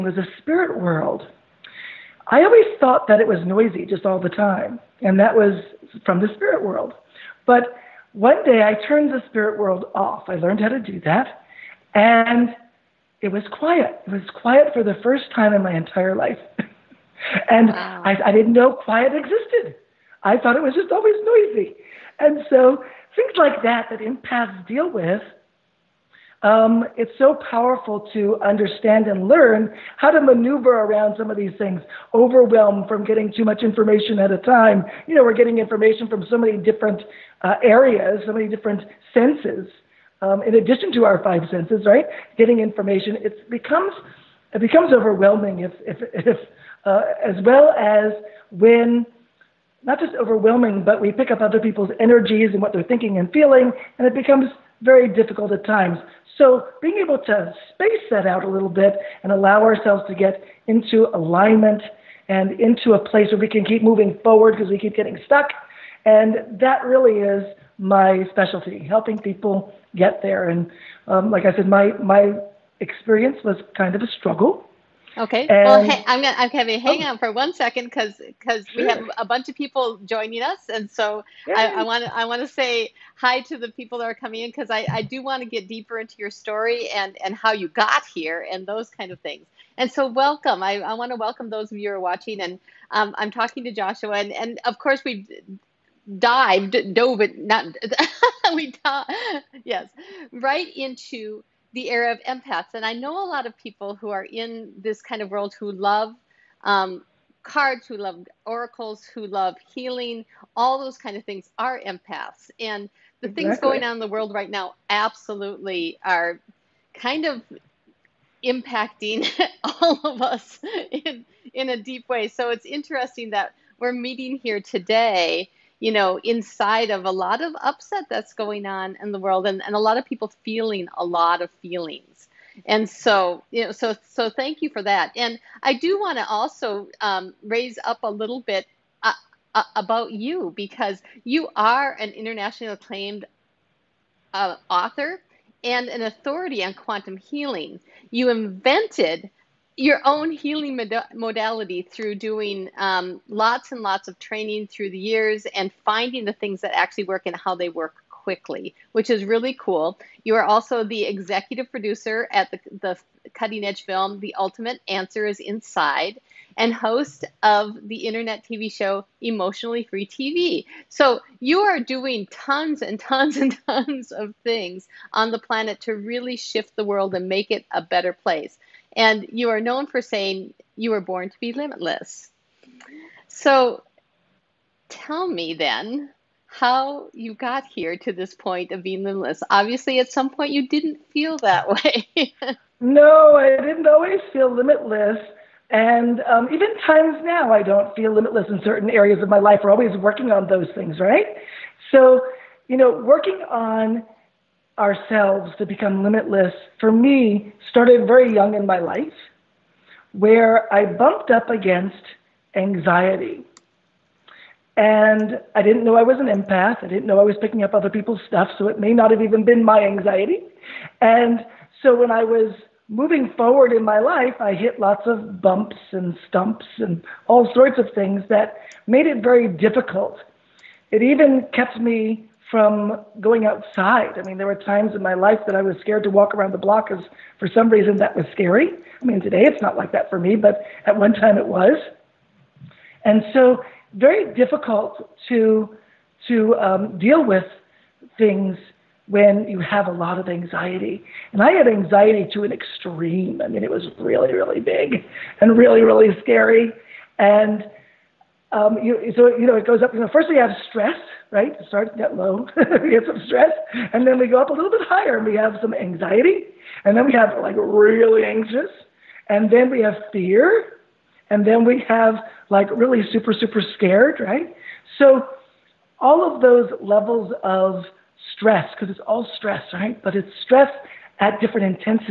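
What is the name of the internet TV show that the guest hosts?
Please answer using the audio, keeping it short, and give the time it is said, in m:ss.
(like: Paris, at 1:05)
Emotionally Free TV, at 2:49.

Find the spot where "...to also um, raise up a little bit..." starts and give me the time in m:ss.
2:16.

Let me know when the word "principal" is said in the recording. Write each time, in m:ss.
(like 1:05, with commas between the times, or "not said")
not said.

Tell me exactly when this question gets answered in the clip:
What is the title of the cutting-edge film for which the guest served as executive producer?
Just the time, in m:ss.
2:44.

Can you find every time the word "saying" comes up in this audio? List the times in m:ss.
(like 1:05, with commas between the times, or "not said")
3:00.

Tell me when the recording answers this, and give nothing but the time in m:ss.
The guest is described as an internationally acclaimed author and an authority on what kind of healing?
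2:26.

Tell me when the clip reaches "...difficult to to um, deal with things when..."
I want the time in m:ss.
4:04.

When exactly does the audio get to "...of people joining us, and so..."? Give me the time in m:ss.
1:19.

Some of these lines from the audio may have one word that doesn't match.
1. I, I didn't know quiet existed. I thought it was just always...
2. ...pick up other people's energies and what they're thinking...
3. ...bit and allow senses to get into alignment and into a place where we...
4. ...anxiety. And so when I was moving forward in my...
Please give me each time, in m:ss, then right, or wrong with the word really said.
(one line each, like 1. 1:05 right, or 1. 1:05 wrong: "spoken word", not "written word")
1. 0:18 right
2. 0:51 right
3. 0:58 wrong: "ourselves", not "senses"
4. 3:39 right.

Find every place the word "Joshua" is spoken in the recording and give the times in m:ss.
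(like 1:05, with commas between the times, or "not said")
1:33.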